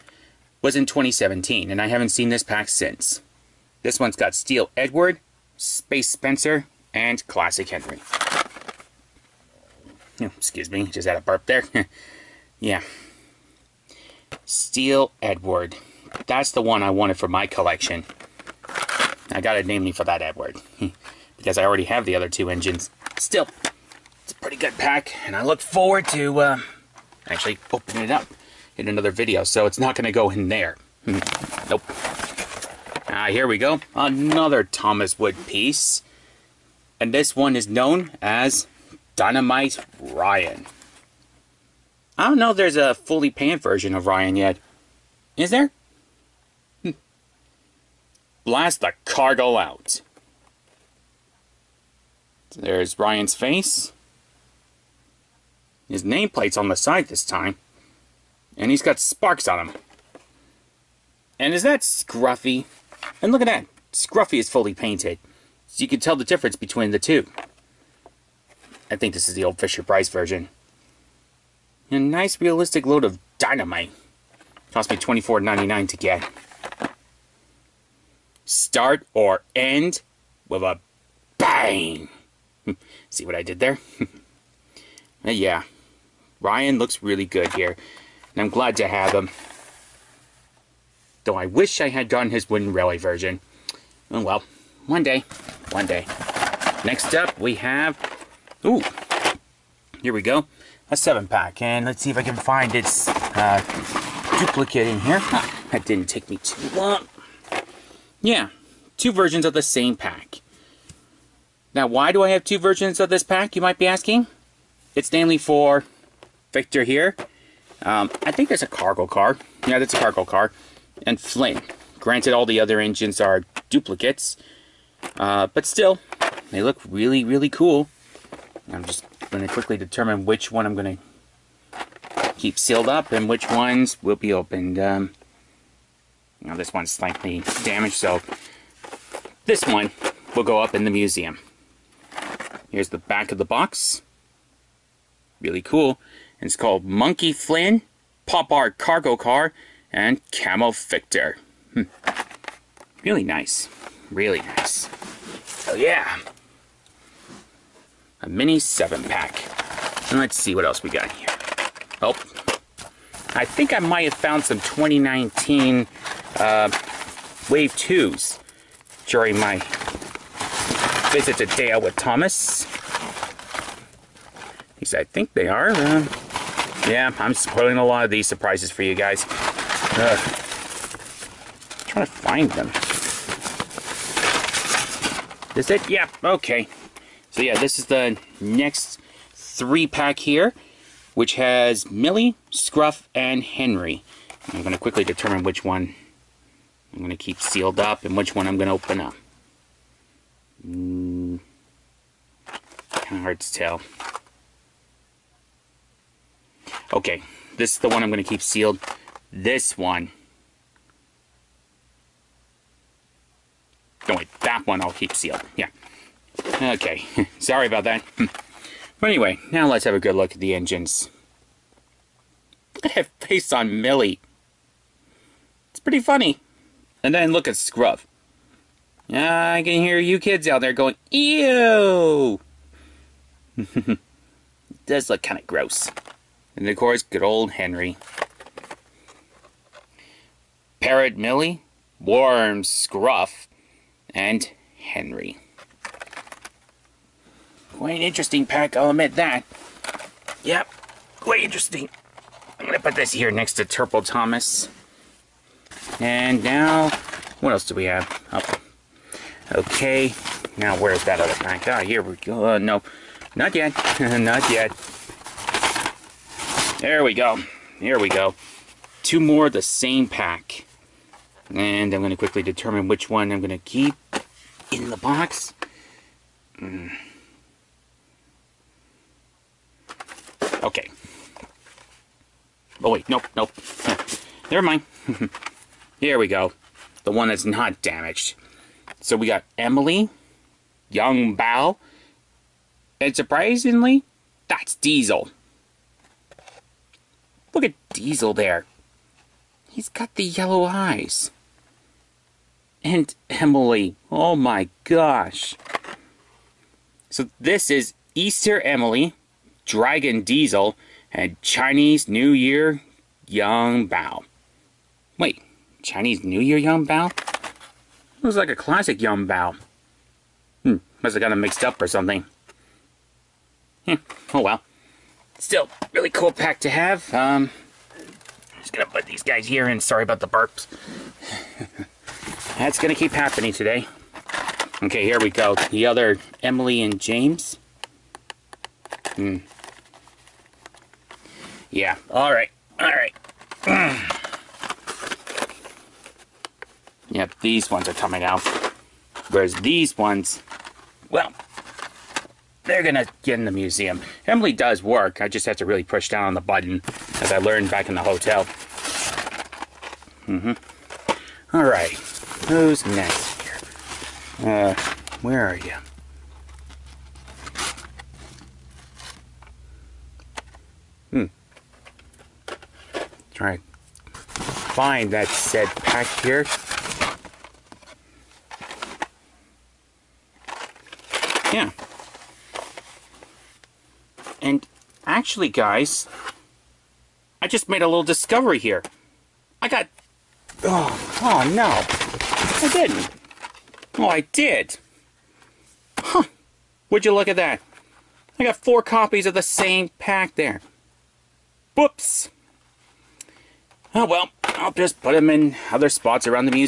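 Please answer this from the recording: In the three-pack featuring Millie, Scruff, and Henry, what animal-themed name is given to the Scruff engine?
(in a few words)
Worm Scruff.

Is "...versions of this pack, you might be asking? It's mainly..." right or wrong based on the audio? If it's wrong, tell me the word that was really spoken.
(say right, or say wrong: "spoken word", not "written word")
right.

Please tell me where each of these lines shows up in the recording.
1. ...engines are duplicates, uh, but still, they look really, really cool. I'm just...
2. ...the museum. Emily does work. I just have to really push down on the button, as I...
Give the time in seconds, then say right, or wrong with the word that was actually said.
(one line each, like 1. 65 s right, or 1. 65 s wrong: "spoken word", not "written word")
1. 122 s right
2. 353 s right.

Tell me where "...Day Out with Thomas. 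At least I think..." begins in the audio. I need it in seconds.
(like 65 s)
171 s.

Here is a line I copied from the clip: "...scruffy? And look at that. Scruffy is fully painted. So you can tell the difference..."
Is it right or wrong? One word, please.
right.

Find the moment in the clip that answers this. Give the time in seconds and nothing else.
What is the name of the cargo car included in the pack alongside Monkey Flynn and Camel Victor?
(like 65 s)
148 s.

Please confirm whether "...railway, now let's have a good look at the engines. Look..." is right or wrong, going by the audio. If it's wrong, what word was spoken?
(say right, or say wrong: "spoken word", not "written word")
wrong: "anyway", not "railway".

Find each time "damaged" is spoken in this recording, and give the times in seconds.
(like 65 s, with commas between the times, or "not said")
137 s, 287 s.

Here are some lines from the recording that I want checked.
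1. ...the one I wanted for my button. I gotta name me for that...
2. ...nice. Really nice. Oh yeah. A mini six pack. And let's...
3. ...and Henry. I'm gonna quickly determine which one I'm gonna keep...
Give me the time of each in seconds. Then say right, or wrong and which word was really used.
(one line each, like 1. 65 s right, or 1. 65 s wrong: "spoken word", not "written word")
1. 16 s wrong: "collection", not "button"
2. 153 s wrong: "seven", not "six"
3. 193 s right.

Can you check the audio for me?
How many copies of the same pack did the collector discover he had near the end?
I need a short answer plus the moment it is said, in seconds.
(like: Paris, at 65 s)
4, at 398 s.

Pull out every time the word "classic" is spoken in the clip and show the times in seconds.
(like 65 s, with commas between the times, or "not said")
7 s, 318 s.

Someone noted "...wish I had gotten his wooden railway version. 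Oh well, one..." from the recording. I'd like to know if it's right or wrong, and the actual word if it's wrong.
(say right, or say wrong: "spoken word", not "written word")
right.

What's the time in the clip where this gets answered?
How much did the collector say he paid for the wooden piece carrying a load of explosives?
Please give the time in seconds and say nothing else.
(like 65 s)
74 s.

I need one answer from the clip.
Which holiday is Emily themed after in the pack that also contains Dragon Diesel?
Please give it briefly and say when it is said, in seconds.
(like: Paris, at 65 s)
Easter, at 308 s.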